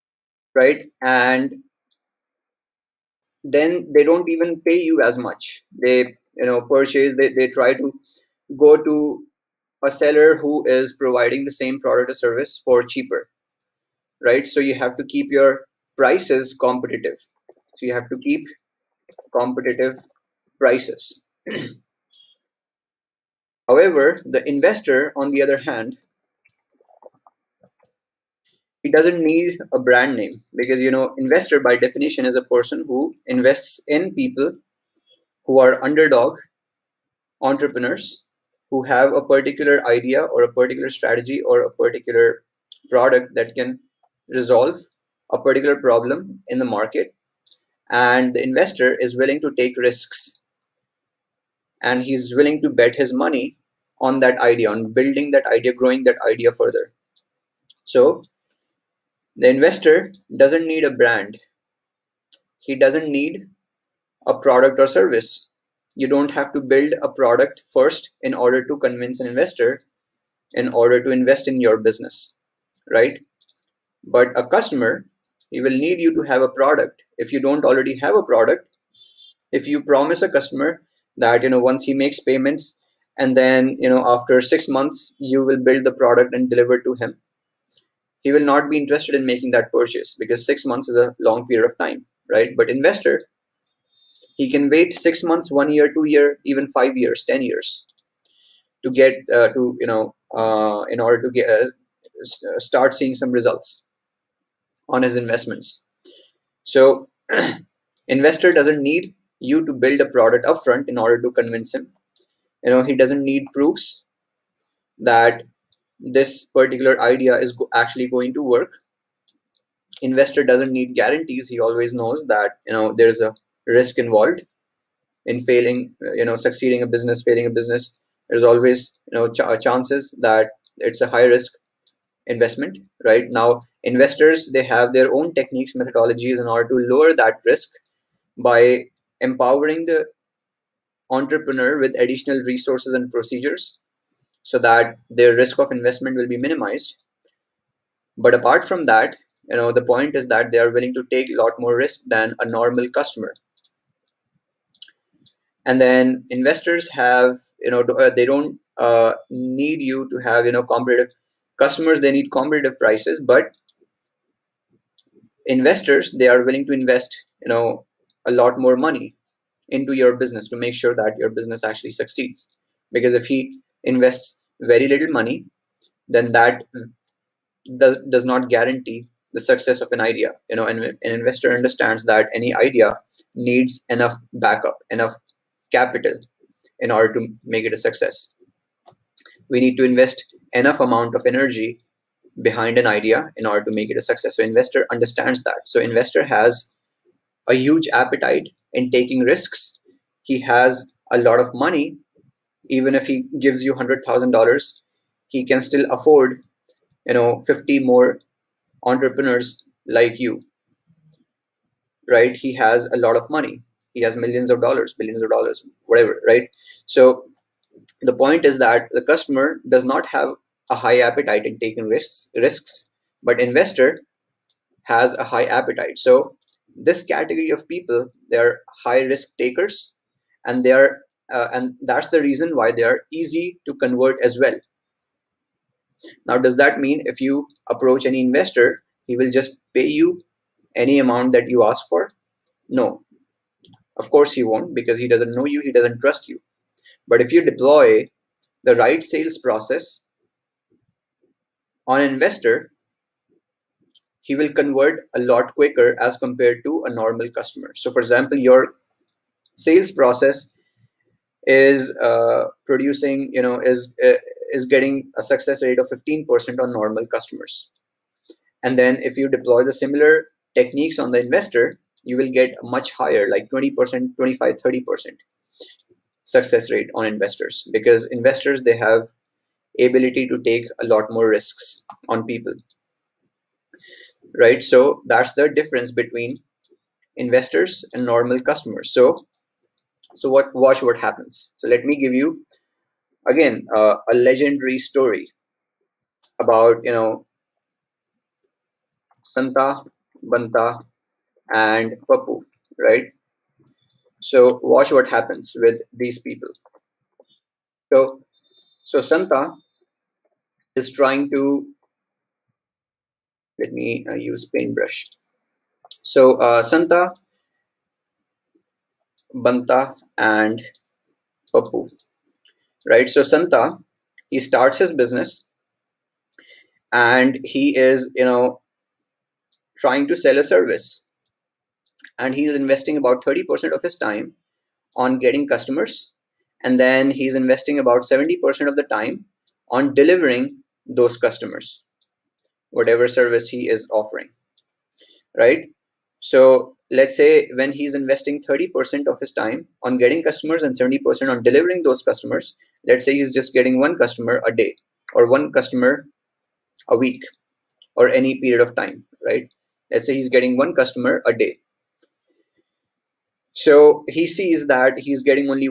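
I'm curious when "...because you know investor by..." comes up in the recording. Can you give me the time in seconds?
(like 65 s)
30 s.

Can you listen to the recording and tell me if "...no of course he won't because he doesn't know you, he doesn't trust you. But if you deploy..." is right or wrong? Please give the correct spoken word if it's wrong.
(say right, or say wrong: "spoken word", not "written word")
right.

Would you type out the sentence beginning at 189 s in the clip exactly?
We need to invest enough amount of energy behind an idea in order to make it a success.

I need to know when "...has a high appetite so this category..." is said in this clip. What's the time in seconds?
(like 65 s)
224 s.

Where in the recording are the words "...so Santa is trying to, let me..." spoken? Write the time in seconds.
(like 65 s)
308 s.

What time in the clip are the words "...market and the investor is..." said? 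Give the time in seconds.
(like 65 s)
46 s.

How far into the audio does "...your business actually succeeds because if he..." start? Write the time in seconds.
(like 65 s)
171 s.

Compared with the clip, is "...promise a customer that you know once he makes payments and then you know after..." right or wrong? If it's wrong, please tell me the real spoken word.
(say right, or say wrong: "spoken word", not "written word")
right.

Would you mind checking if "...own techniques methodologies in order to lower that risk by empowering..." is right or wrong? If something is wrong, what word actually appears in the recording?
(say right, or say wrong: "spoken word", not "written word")
right.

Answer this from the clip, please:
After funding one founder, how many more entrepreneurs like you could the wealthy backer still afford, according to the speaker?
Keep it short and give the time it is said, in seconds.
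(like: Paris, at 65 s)
50, at 207 s.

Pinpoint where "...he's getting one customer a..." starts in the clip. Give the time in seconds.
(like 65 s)
360 s.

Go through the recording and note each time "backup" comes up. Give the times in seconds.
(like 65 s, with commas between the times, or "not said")
184 s.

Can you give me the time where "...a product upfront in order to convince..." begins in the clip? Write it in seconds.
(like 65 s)
110 s.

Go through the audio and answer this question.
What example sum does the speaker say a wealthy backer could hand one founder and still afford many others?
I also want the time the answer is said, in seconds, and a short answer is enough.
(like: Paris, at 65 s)
$100,000, at 203 s.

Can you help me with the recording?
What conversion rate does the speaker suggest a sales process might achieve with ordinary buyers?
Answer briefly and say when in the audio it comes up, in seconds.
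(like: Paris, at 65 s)
15%, at 265 s.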